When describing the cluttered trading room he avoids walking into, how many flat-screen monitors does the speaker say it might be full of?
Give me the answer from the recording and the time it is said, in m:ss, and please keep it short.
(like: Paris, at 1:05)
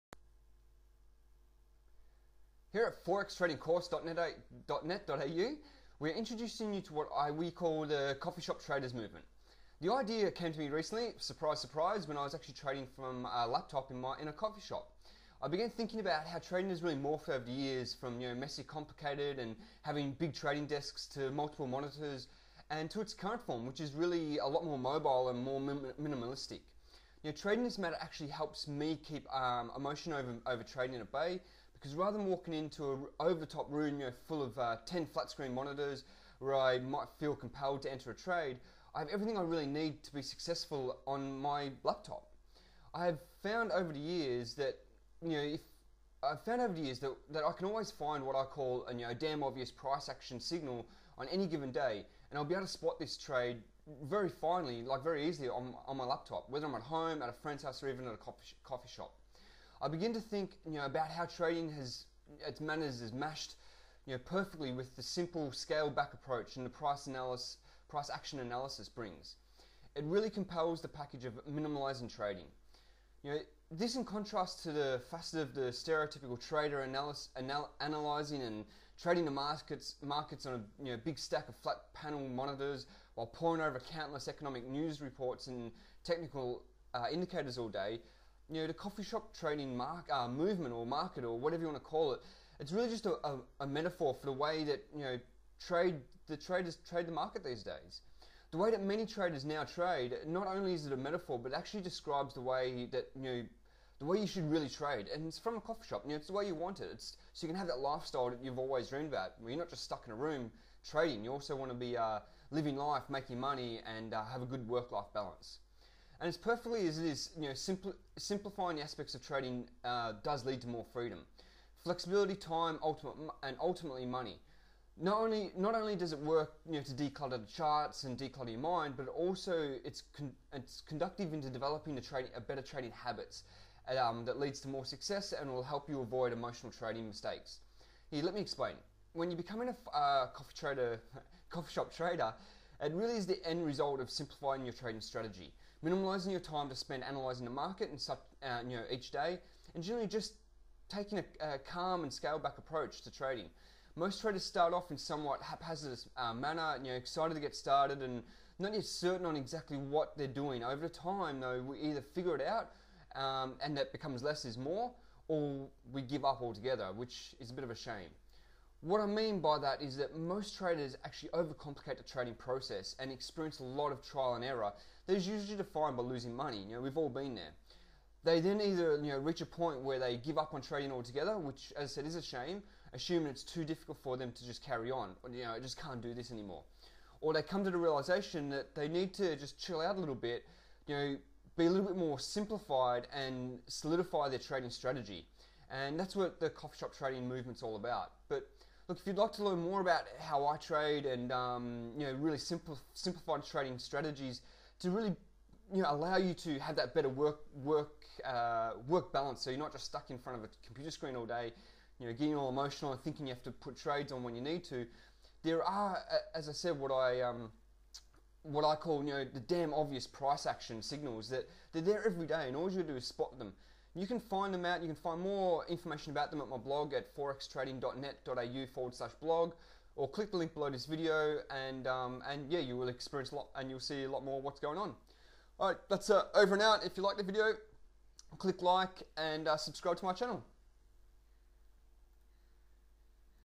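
10, at 0:34.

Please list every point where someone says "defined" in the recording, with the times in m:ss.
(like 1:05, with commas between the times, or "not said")
2:55.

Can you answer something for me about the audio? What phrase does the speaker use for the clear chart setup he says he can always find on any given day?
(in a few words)
damn obvious price action signal.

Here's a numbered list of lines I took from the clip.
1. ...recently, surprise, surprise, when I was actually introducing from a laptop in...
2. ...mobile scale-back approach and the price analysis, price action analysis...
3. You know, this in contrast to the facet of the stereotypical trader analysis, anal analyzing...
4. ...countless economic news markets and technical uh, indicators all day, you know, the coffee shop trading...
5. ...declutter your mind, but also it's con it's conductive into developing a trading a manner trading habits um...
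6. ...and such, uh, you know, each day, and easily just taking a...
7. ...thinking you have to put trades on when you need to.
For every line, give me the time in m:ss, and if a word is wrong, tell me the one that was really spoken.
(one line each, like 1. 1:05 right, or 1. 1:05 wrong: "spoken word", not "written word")
1. 0:10 wrong: "trading", not "introducing"
2. 1:05 wrong: "simple", not "mobile"
3. 1:13 right
4. 1:23 wrong: "reports", not "markets"
5. 2:08 wrong: "better", not "manner"
6. 2:27 wrong: "generally", not "easily"
7. 3:33 right.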